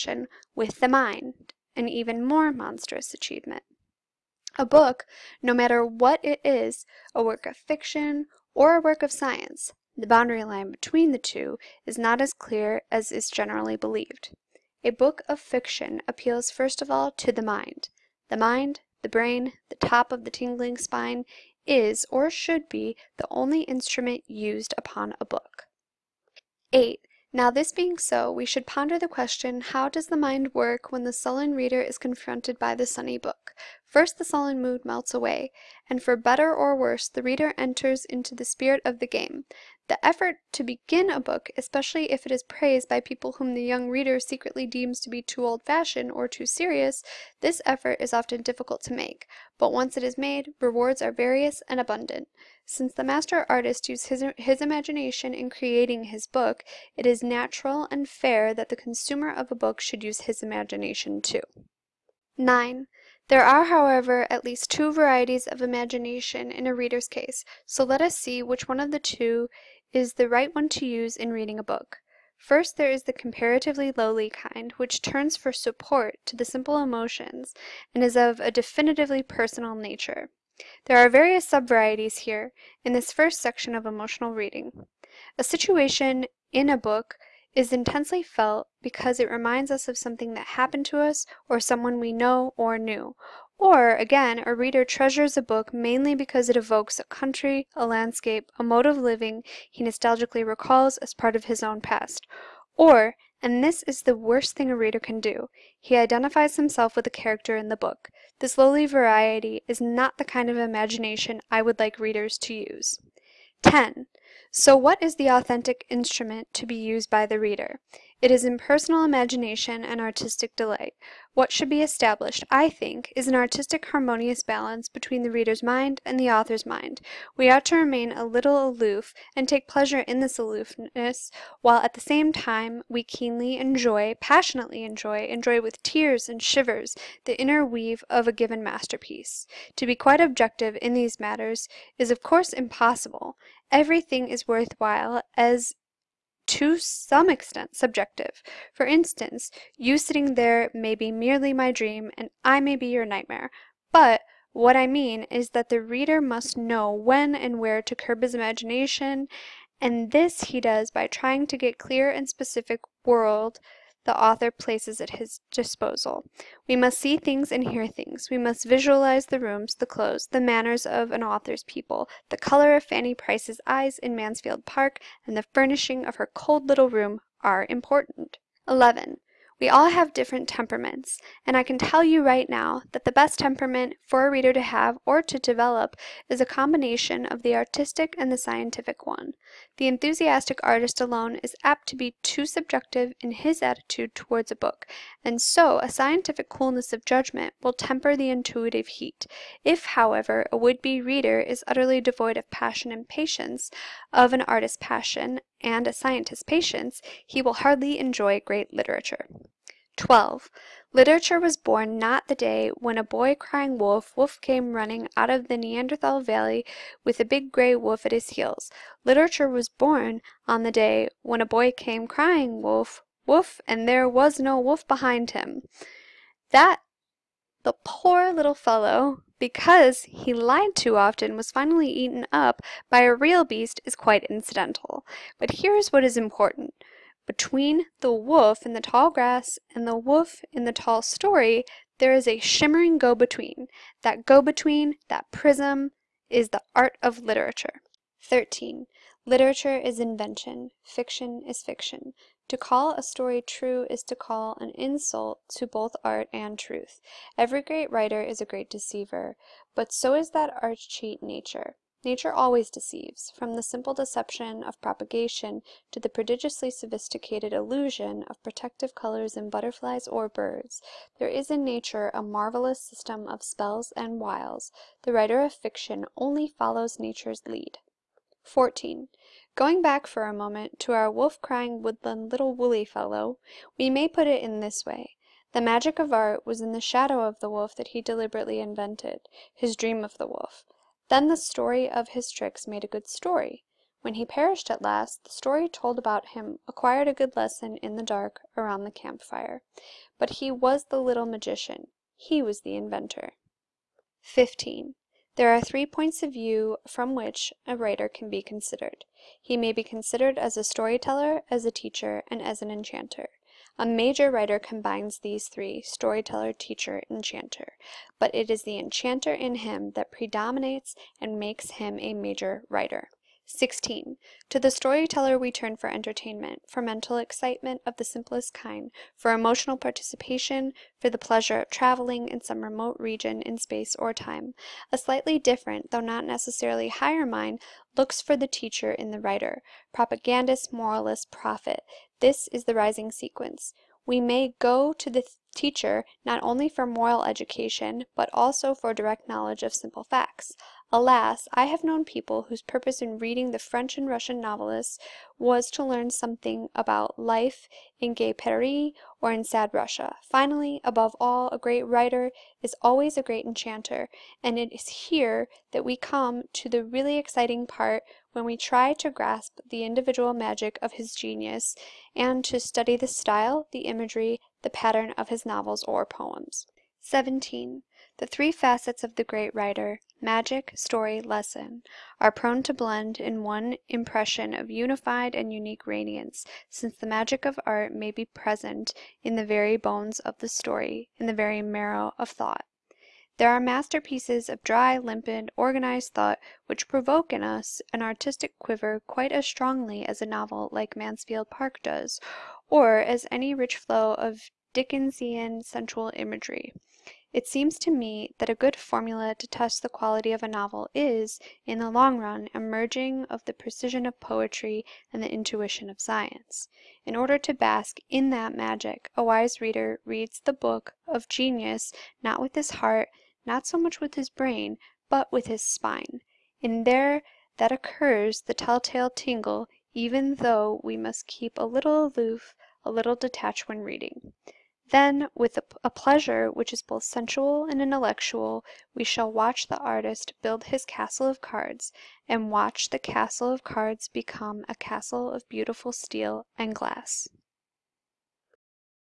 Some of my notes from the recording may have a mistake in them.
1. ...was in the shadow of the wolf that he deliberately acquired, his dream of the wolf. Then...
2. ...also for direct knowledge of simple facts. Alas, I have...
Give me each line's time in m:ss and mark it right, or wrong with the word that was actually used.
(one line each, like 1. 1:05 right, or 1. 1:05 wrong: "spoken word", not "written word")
1. 4:46 wrong: "invented", not "acquired"
2. 5:48 right.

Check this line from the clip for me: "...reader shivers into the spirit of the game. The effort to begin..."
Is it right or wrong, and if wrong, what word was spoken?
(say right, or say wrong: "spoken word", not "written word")
wrong: "enters", not "shivers".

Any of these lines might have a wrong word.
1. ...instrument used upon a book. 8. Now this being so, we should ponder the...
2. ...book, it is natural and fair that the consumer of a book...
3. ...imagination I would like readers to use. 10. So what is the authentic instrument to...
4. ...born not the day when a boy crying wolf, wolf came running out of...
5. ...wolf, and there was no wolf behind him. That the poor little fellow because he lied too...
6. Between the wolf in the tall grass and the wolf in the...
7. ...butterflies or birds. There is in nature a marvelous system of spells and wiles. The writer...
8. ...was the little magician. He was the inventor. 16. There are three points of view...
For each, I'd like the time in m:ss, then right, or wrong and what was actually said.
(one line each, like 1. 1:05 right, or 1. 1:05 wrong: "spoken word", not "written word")
1. 0:23 right
2. 0:56 right
3. 1:50 right
4. 3:31 right
5. 3:43 right
6. 3:57 right
7. 4:29 right
8. 5:00 wrong: "15", not "16".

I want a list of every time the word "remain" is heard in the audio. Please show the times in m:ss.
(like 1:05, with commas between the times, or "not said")
2:07.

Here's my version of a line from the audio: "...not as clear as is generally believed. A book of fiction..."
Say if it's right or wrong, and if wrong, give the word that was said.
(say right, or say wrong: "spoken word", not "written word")
right.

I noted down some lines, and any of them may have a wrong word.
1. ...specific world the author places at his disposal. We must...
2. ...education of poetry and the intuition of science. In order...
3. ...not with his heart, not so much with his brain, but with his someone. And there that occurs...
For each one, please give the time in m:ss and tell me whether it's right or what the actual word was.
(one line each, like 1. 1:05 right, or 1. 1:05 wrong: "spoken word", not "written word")
1. 2:42 right
2. 6:53 wrong: "precision", not "education"
3. 7:02 wrong: "spine", not "someone".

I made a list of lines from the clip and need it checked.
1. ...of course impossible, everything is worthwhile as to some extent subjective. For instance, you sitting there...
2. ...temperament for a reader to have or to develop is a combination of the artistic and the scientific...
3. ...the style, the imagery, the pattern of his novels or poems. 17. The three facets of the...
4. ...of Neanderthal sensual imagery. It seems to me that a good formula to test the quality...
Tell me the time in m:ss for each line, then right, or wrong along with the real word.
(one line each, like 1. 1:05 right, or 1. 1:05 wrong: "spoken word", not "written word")
1. 2:22 right
2. 3:03 right
3. 6:12 right
4. 6:44 wrong: "Dickensian", not "Neanderthal".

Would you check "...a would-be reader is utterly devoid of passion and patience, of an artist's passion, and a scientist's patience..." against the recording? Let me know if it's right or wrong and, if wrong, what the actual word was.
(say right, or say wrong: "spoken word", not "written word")
right.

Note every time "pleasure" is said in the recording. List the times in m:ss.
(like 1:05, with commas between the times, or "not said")
2:09, 5:31, 7:15.